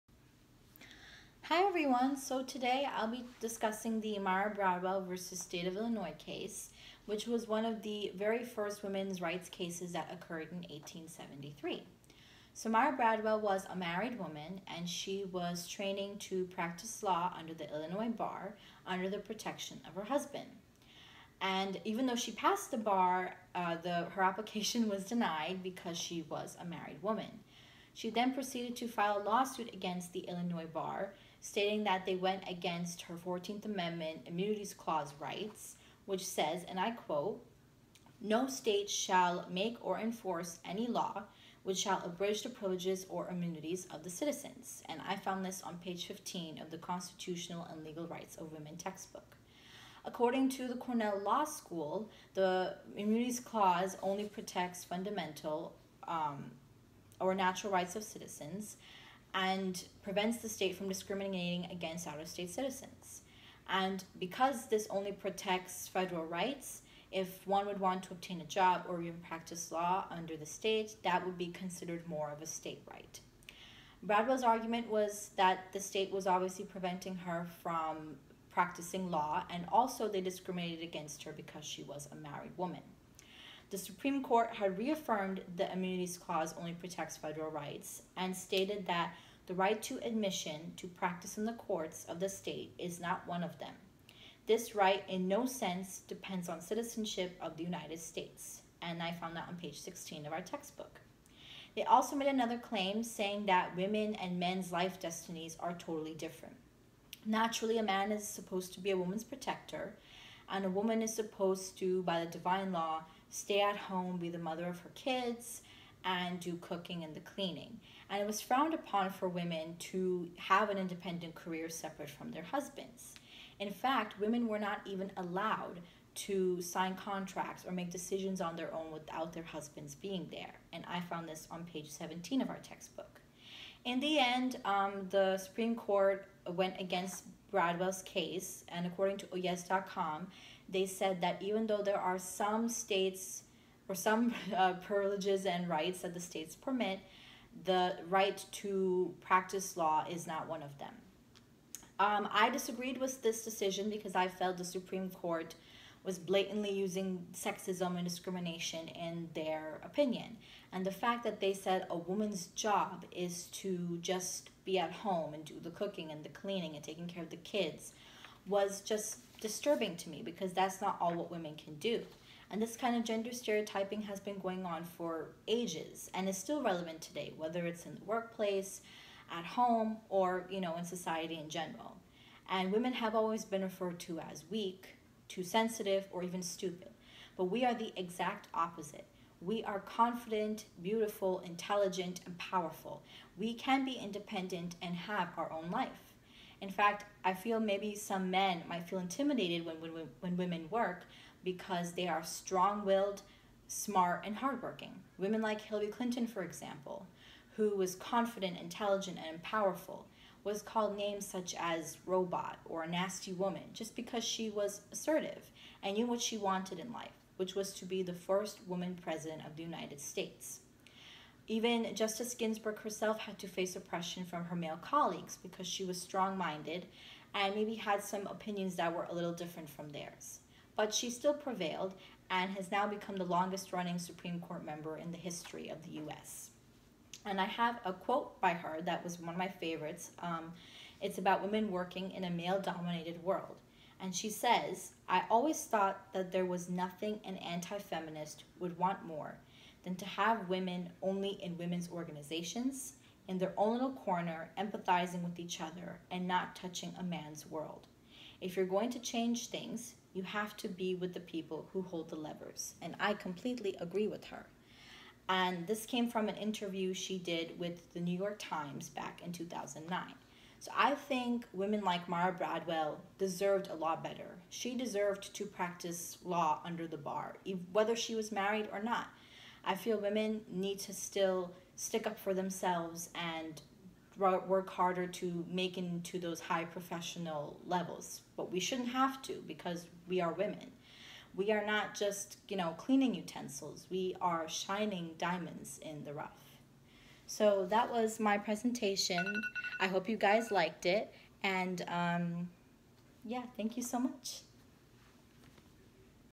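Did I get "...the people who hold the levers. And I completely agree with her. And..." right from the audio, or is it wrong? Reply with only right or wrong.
right.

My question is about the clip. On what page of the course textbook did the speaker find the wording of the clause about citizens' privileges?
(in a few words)
15.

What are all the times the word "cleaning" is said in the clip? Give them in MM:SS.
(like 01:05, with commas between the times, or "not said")
01:57, 02:46, 04:52.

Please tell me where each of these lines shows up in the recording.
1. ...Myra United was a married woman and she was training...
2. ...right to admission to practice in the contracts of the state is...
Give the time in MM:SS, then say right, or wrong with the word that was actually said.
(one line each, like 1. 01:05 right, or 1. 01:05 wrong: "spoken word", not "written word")
1. 00:12 wrong: "Bradwell", not "United"
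2. 01:29 wrong: "courts", not "contracts".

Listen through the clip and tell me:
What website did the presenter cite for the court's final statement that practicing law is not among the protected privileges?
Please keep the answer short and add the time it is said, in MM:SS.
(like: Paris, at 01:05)
oyez.com, at 02:19.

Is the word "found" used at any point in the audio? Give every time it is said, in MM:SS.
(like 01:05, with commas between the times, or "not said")
00:45, 01:39, 02:11.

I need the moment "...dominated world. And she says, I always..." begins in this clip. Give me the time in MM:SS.
04:02.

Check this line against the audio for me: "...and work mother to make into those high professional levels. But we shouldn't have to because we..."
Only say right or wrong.
wrong.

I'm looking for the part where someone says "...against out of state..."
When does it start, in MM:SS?
01:01.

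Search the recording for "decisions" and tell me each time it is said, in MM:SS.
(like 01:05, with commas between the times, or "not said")
02:07, 02:33.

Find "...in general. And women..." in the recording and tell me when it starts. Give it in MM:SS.
03:01.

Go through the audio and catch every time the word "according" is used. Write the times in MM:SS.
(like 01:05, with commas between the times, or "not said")
00:50, 02:18.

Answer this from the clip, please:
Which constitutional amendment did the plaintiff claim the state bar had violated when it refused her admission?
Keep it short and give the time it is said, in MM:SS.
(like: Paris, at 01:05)
14th Amendment, at 00:33.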